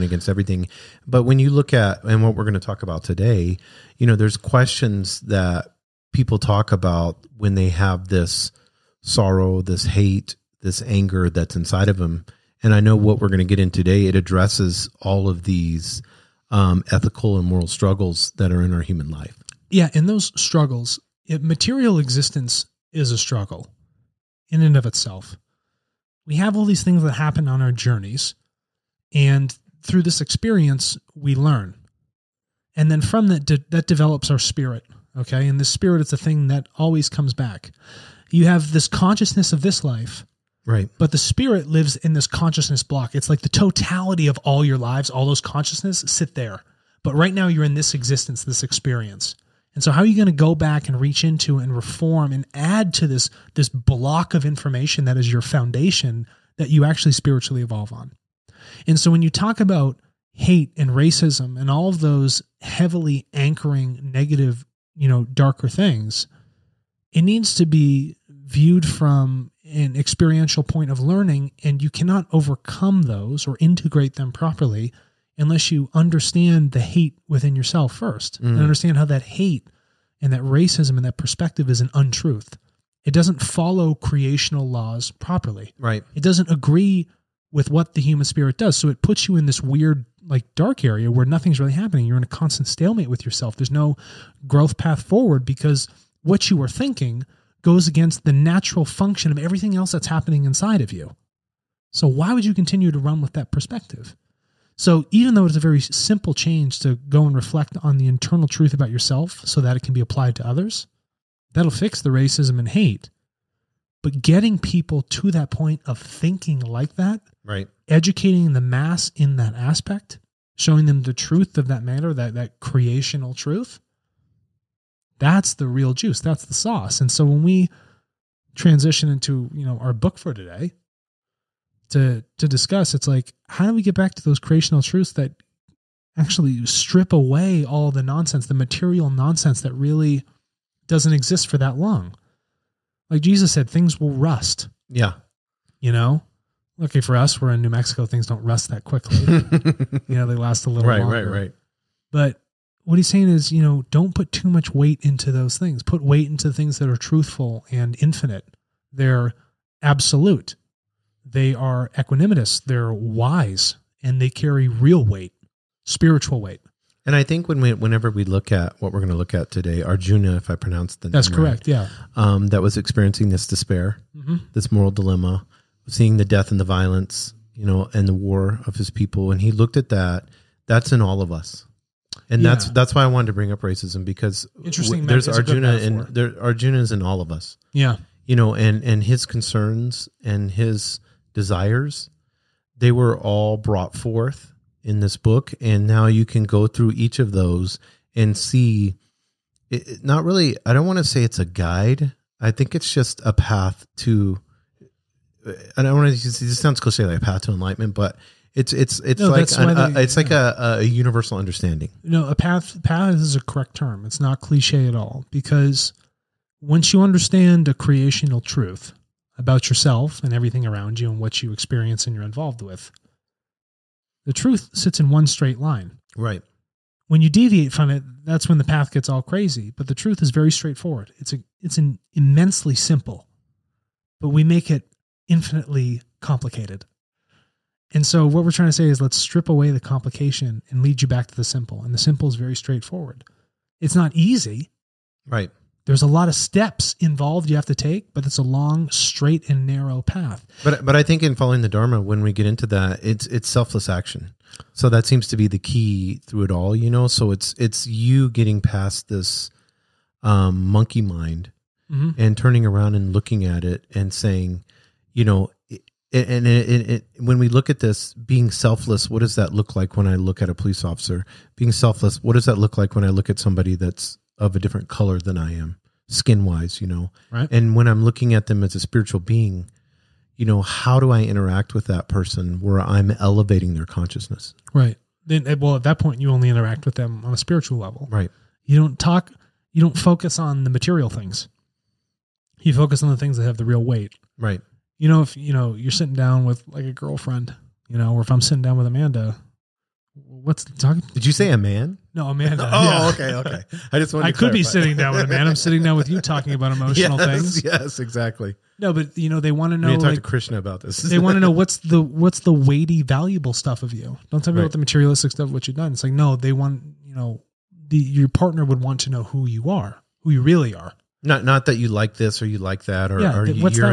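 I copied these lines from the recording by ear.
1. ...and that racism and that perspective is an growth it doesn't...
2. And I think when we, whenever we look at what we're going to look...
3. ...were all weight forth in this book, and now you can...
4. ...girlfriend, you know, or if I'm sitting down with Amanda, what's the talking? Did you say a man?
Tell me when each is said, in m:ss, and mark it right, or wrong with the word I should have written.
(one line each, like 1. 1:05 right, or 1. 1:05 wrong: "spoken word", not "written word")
1. 1:20 wrong: "untruth", not "growth"
2. 2:47 right
3. 3:12 wrong: "brought", not "weight"
4. 4:56 right.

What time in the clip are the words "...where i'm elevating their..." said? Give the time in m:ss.
4:42.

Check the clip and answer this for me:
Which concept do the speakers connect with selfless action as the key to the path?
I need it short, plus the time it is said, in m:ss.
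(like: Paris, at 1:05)
Dharma, at 4:11.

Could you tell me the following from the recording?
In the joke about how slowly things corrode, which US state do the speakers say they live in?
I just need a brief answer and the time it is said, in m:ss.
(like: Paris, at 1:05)
New Mexico, at 2:27.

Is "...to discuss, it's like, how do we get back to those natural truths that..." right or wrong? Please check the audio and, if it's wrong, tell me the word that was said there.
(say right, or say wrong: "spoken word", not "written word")
wrong: "creational", not "natural".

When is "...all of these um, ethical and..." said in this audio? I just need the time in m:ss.
0:15.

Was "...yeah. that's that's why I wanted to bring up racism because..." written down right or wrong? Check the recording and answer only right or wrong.
right.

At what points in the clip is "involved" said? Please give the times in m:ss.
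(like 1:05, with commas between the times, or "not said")
3:42, 4:06.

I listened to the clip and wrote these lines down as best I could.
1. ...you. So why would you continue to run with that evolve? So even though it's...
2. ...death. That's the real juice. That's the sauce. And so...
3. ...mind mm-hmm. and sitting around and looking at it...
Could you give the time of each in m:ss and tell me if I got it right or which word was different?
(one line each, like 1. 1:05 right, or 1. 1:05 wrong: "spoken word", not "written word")
1. 1:40 wrong: "perspective", not "evolve"
2. 2:03 wrong: "truth", not "death"
3. 4:21 wrong: "turning", not "sitting".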